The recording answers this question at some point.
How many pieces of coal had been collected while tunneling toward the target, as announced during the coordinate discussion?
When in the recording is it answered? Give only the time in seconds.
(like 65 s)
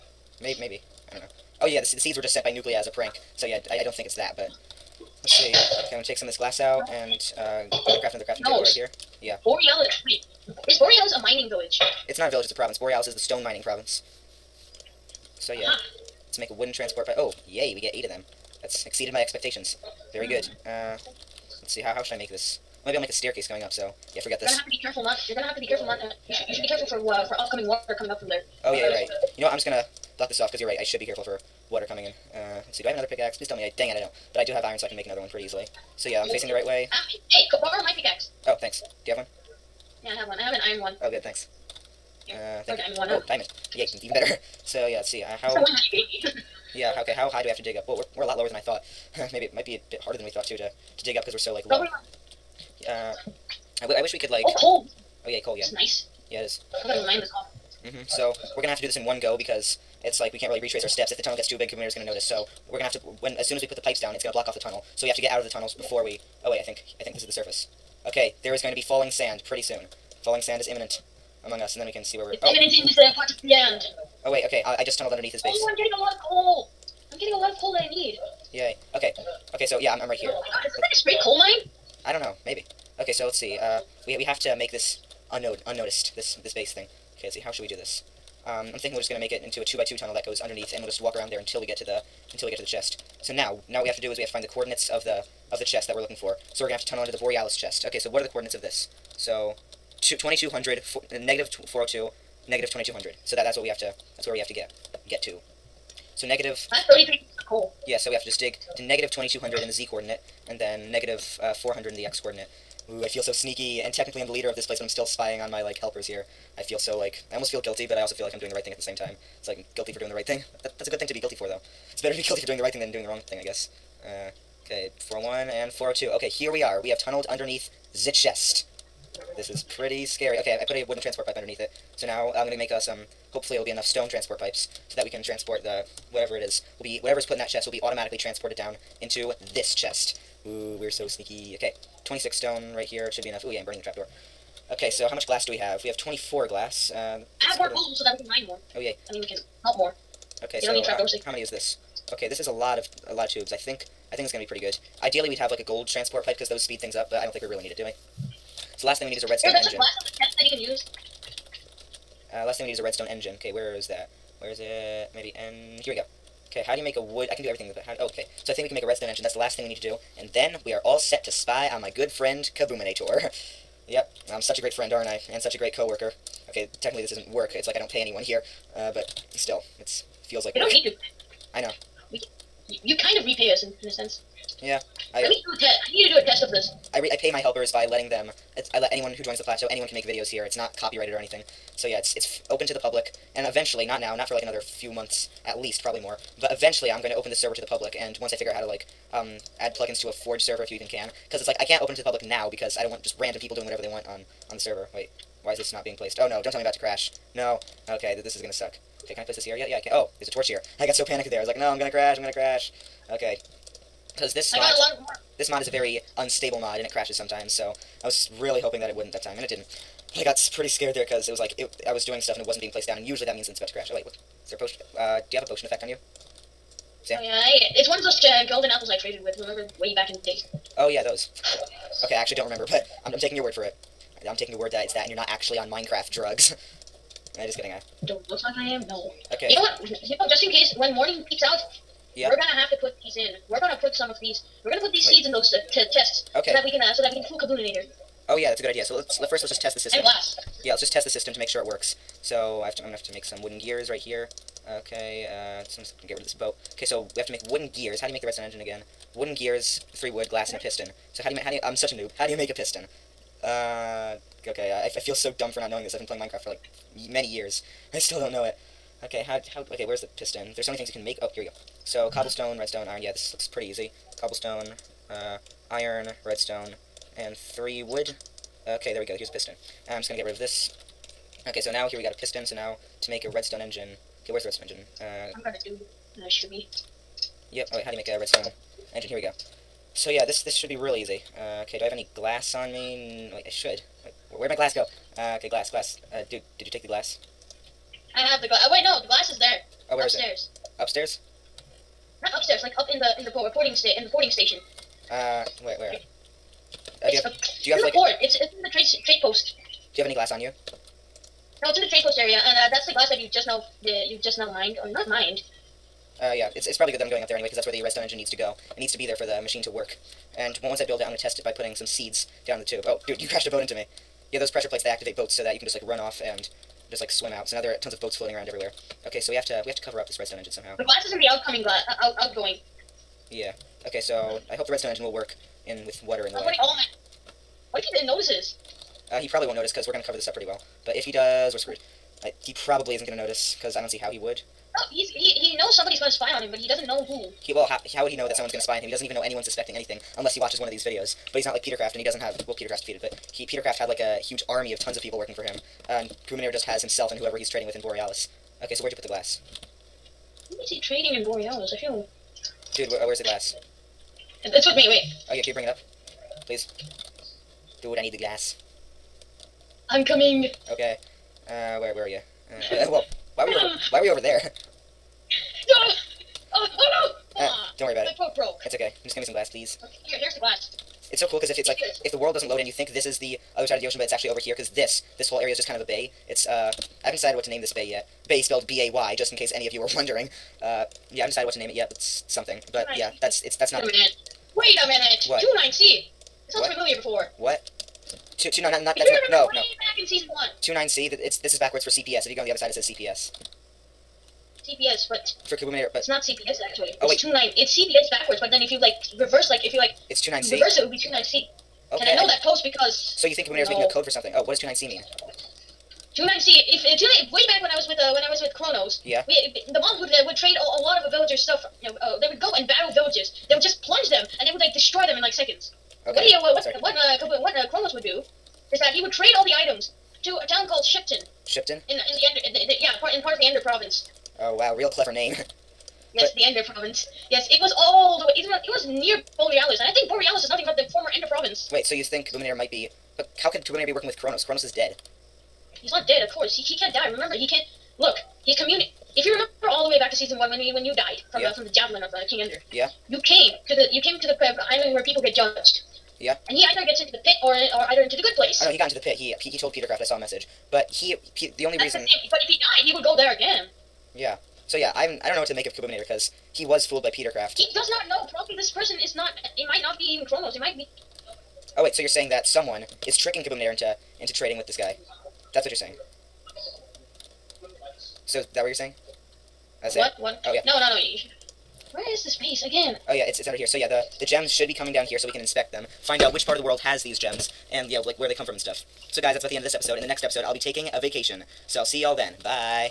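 106 s.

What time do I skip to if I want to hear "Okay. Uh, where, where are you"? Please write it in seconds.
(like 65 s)
370 s.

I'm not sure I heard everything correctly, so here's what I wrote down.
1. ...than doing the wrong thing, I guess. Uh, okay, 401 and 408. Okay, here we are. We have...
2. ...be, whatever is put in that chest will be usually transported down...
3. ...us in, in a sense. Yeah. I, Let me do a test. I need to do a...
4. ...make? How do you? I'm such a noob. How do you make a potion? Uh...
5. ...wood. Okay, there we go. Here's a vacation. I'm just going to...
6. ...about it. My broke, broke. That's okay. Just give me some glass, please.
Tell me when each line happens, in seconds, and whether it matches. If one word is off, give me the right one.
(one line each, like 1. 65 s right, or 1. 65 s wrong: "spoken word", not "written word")
1. 122 s wrong: "402", not "408"
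2. 136 s wrong: "automatically", not "usually"
3. 183 s right
4. 261 s wrong: "piston", not "potion"
5. 277 s wrong: "piston", not "vacation"
6. 377 s right.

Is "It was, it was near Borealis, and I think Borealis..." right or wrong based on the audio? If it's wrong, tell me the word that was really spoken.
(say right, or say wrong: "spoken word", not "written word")
right.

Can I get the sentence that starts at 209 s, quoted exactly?
Okay, can I place this here yet?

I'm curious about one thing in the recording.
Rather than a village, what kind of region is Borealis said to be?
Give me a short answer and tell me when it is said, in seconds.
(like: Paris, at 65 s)
stone mining province, at 13 s.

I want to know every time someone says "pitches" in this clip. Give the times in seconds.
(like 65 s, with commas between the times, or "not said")
not said.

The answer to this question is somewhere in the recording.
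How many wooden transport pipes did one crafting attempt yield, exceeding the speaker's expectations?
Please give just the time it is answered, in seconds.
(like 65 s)
17 s.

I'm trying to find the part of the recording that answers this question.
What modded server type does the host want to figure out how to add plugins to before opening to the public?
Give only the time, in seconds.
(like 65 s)
200 s.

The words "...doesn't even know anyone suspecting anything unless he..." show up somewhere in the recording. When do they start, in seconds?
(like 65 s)
348 s.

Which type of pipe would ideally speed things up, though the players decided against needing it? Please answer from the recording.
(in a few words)
gold transport pipe.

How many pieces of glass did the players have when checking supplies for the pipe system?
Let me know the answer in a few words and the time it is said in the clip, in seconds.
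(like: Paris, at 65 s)
24, at 145 s.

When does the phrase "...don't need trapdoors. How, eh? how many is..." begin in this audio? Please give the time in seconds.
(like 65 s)
150 s.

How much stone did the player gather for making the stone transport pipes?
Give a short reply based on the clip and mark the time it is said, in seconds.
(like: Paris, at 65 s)
26, at 142 s.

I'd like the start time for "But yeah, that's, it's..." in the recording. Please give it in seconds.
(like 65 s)
392 s.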